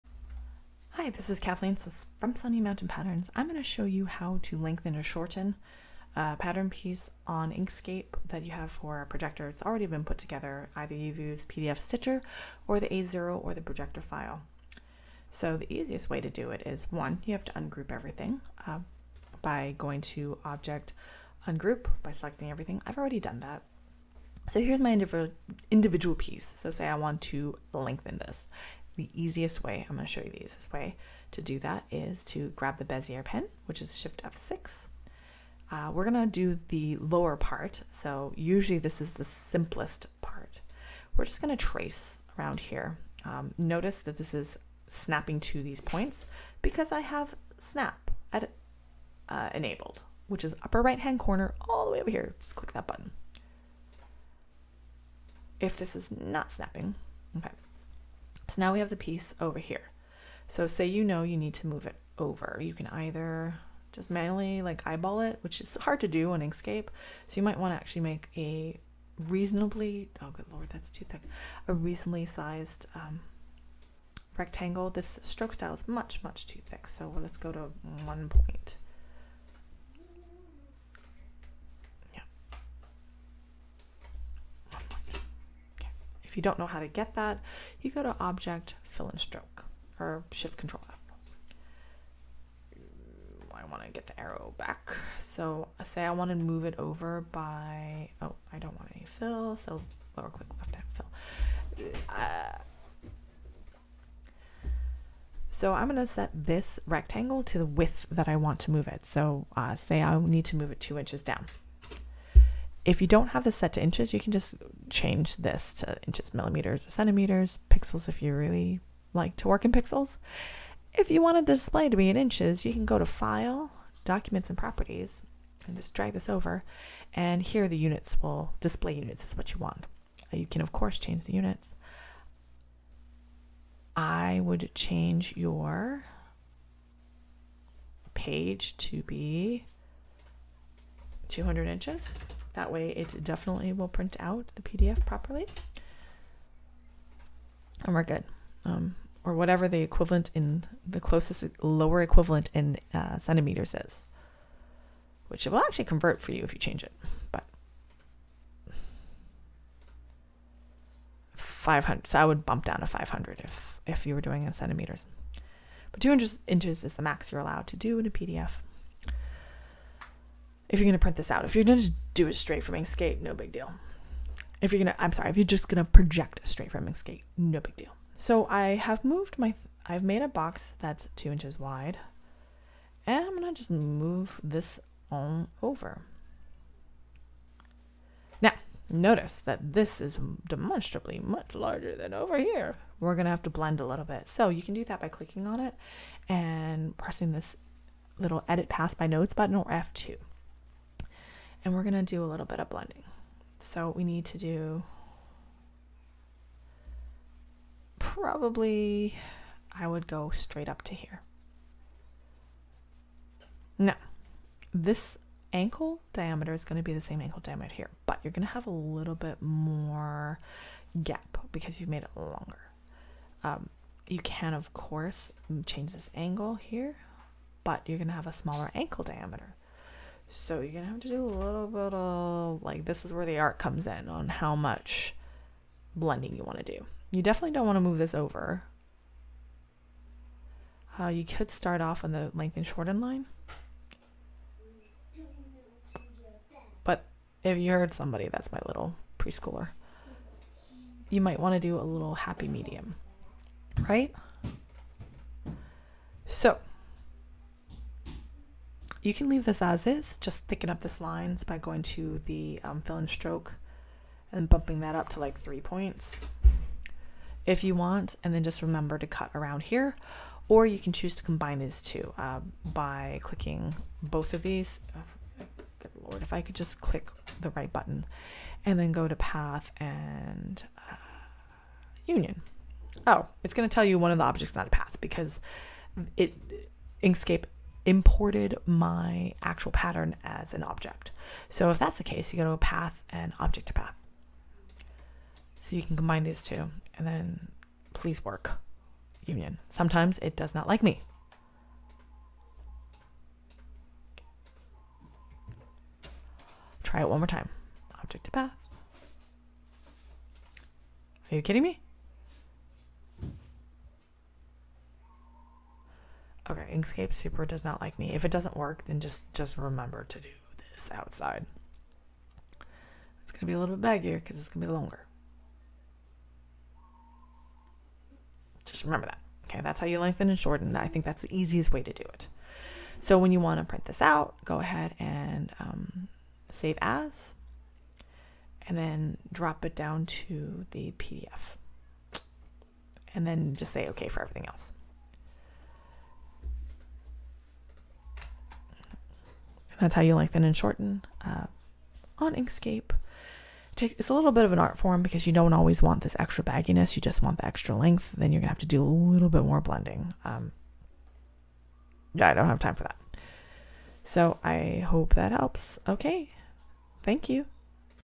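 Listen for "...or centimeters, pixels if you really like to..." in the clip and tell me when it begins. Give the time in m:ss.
1:56.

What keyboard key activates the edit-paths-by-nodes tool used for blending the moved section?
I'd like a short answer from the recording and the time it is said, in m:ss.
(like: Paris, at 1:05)
F2, at 3:19.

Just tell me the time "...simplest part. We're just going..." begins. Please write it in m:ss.
0:39.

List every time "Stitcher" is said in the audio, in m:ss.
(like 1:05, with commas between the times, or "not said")
0:11.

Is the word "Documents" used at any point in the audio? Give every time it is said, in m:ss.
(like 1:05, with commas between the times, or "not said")
2:04.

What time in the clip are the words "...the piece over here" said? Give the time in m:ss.
0:58.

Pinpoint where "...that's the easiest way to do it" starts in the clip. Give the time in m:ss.
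5:31.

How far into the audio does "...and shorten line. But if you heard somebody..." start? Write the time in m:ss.
4:02.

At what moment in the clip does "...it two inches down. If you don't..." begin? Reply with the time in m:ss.
1:50.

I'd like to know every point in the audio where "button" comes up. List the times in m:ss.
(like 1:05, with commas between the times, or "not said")
0:52, 3:19, 4:37.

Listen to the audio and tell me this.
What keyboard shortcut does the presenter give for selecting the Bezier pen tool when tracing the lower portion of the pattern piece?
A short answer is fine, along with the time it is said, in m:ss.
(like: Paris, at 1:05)
Shift F6, at 0:33.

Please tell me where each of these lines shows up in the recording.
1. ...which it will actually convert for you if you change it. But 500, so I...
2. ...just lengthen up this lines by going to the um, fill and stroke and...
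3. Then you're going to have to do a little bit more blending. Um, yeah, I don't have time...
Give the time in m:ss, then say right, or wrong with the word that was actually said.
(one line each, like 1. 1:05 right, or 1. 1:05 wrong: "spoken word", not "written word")
1. 2:35 right
2. 4:20 wrong: "thicken", not "lengthen"
3. 5:58 right.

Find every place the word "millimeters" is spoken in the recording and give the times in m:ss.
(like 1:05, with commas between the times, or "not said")
1:56.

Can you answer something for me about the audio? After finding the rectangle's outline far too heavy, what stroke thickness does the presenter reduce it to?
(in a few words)
1 point.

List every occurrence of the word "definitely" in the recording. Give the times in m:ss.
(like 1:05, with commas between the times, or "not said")
2:23, 3:57.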